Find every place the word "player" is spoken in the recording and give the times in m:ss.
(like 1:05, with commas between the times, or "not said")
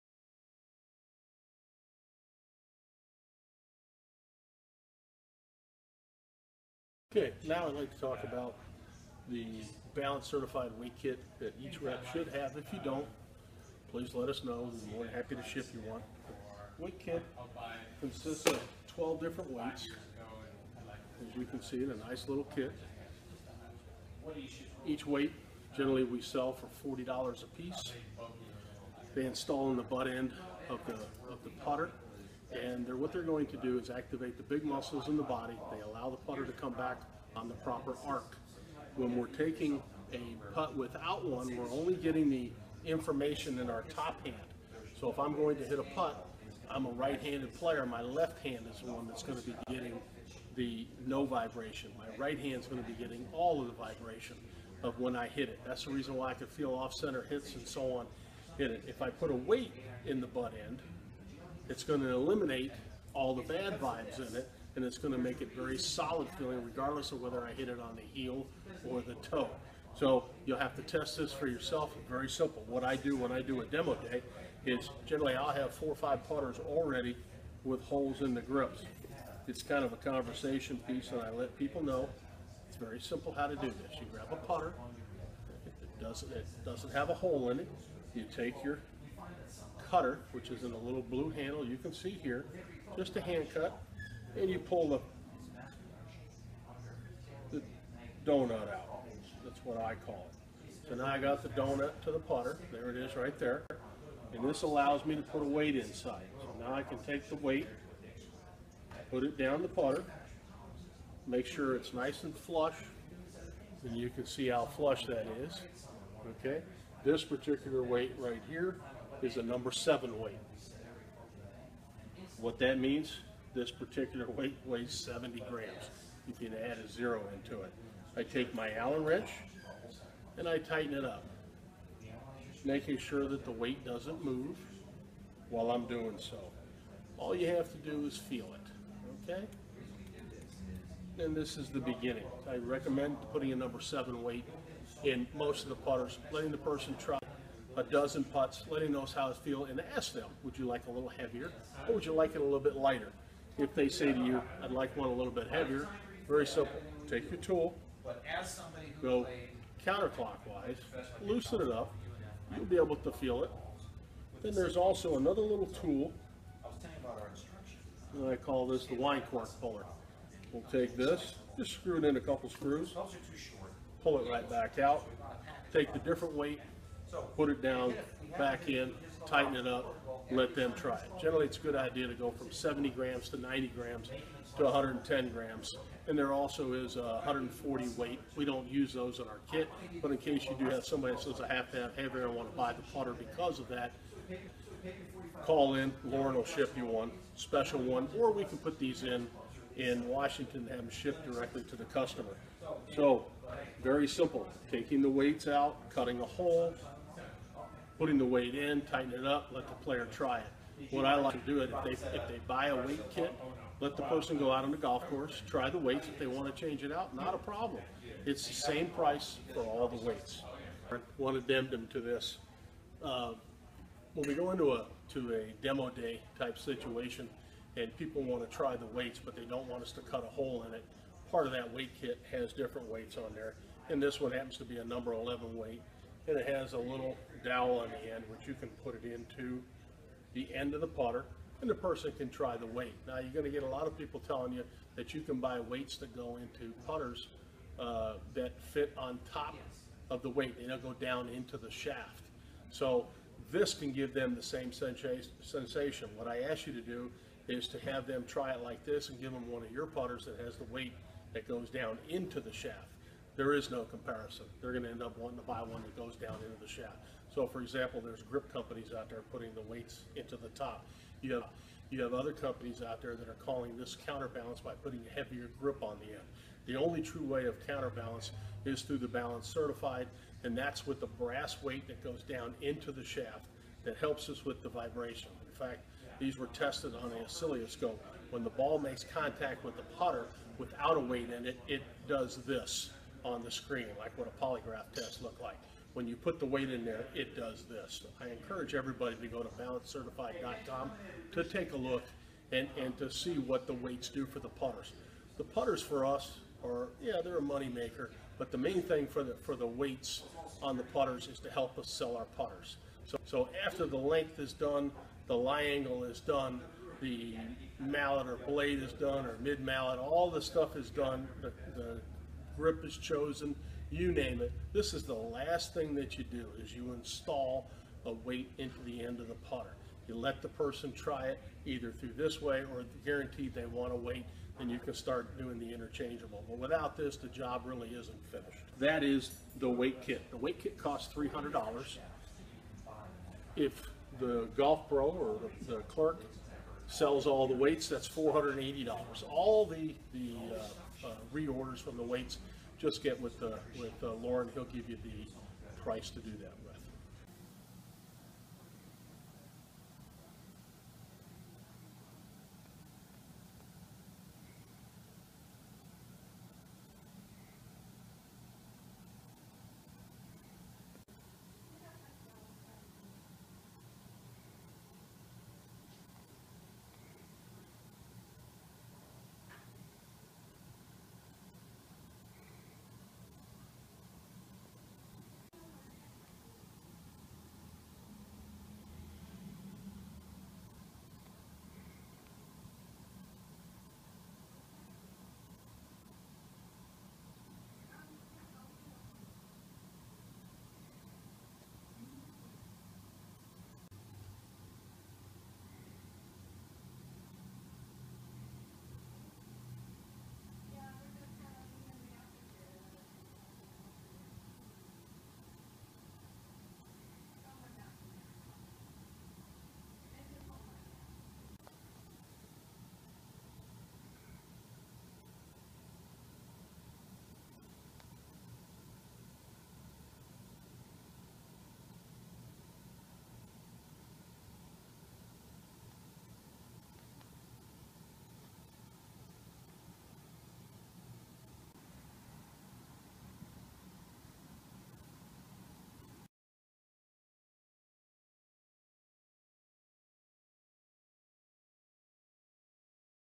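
0:47, 3:29.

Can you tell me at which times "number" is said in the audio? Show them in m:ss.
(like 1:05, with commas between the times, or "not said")
1:59, 2:23, 3:54.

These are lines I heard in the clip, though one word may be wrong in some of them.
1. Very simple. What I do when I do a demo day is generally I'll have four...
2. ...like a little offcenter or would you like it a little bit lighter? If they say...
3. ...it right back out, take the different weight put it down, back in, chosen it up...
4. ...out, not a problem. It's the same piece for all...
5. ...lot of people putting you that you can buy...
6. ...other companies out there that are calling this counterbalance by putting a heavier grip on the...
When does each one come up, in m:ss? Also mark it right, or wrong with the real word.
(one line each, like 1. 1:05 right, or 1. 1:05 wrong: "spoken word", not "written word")
1. 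1:12 right
2. 2:30 wrong: "heavier", not "offcenter"
3. 2:54 wrong: "tighten", not "chosen"
4. 3:36 wrong: "price", not "piece"
5. 4:03 wrong: "telling", not "putting"
6. 4:32 right.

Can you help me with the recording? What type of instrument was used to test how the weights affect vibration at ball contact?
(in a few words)
oscilloscope.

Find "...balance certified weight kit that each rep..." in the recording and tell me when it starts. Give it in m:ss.
0:09.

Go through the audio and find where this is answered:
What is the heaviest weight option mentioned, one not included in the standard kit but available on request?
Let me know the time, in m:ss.
3:07.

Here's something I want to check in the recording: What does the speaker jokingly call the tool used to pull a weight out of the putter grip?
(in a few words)
wine cork puller.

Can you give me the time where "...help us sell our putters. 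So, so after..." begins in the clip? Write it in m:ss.
5:11.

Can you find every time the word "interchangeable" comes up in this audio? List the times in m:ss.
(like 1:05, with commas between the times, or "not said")
5:35.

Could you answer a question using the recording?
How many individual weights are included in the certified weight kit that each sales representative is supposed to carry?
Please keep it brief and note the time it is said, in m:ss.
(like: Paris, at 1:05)
12, at 0:18.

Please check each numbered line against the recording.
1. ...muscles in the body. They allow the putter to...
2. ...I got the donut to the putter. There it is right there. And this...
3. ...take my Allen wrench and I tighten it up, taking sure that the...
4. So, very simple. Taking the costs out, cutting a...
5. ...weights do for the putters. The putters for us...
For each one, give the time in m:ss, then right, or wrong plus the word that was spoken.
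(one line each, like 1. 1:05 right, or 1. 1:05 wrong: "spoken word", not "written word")
1. 0:34 right
2. 1:41 right
3. 2:08 wrong: "making", not "taking"
4. 3:22 wrong: "weights", not "costs"
5. 5:03 right.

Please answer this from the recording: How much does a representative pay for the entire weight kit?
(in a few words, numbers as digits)
$300.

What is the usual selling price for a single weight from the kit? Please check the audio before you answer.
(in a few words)
$40.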